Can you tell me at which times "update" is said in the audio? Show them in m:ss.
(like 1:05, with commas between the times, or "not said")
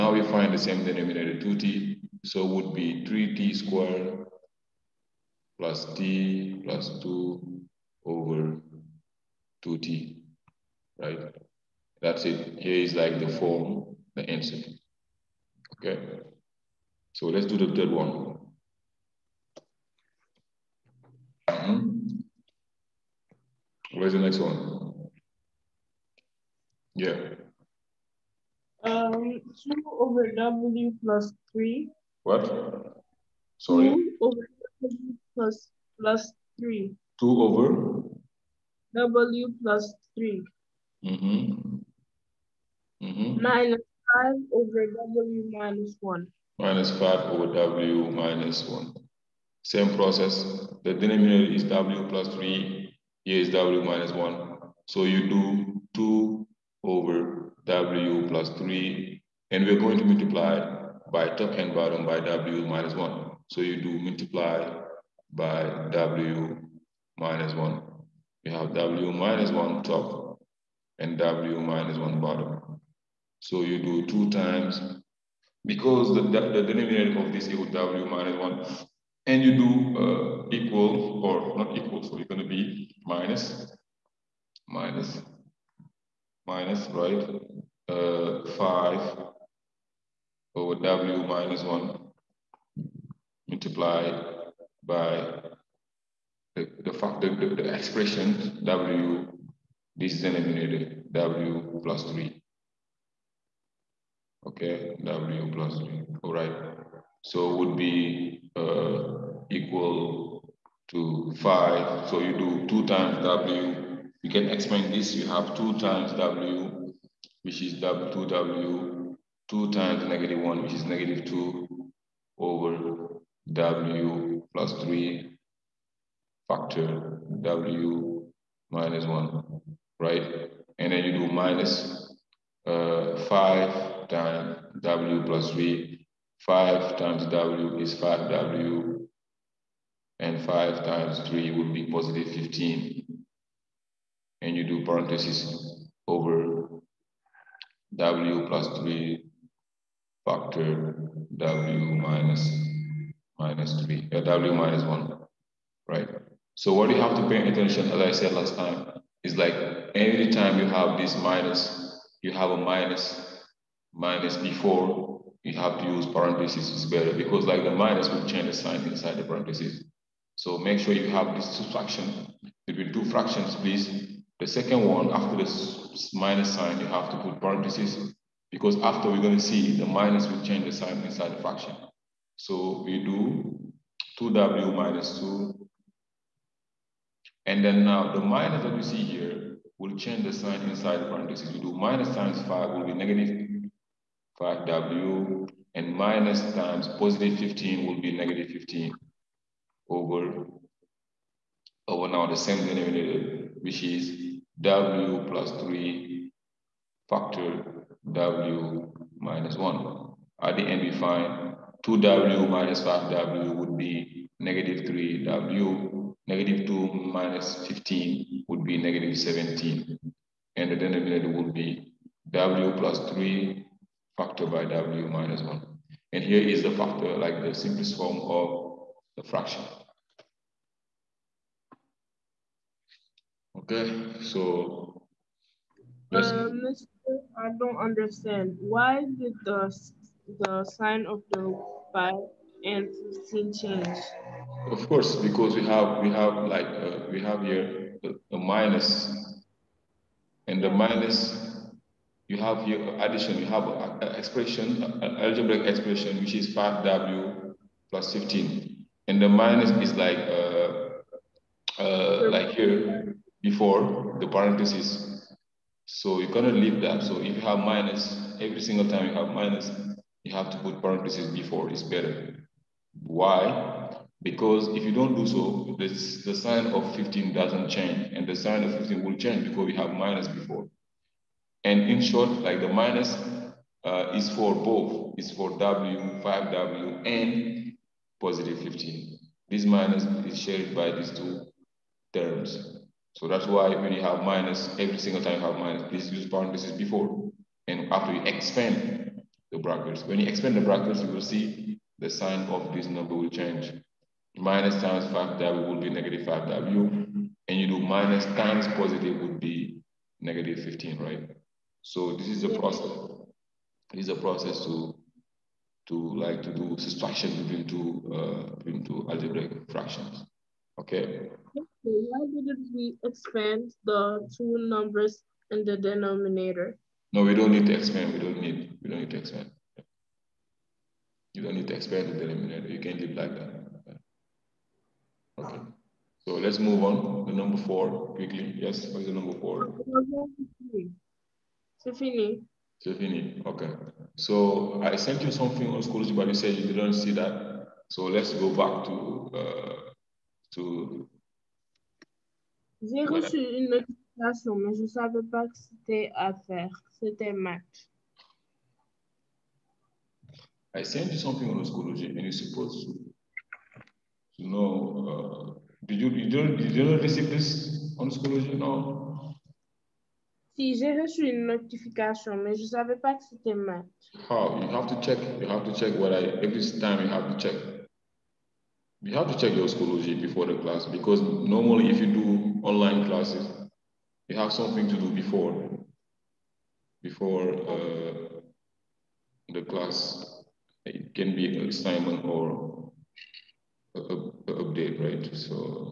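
6:34.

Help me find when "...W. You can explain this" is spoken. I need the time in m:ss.
1:53.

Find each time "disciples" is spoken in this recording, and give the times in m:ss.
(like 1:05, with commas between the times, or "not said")
not said.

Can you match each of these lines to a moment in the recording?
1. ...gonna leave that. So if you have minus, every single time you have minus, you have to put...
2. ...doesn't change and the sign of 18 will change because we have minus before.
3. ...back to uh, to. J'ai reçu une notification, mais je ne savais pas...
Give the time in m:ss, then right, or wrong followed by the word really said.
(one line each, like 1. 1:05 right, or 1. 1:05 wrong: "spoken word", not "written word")
1. 4:26 right
2. 4:37 wrong: "15", not "18"
3. 5:48 right.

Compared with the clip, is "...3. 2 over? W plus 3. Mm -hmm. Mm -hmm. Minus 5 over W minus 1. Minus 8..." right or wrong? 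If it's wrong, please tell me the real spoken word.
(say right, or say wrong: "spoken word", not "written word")
wrong: "5", not "8".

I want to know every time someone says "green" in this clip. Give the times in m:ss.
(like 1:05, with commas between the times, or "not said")
not said.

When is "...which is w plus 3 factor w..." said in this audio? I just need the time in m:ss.
3:23.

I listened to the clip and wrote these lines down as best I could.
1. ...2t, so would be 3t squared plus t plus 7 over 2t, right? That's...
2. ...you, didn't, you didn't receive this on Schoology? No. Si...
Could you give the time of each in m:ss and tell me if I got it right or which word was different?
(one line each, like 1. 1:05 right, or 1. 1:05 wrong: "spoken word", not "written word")
1. 0:01 wrong: "2", not "7"
2. 6:06 right.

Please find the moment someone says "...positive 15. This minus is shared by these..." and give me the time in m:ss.
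4:48.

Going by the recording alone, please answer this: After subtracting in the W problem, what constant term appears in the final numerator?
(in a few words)
-17.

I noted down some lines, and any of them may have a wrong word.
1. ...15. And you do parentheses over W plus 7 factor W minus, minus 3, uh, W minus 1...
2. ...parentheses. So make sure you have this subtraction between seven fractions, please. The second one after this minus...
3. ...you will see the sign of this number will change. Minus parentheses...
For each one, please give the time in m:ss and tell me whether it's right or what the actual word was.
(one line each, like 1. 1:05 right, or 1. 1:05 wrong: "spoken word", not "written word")
1. 2:22 wrong: "3", not "7"
2. 2:49 wrong: "two", not "seven"
3. 5:01 wrong: "times", not "parentheses".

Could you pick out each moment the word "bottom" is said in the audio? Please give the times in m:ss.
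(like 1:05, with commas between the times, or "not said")
1:01, 1:12.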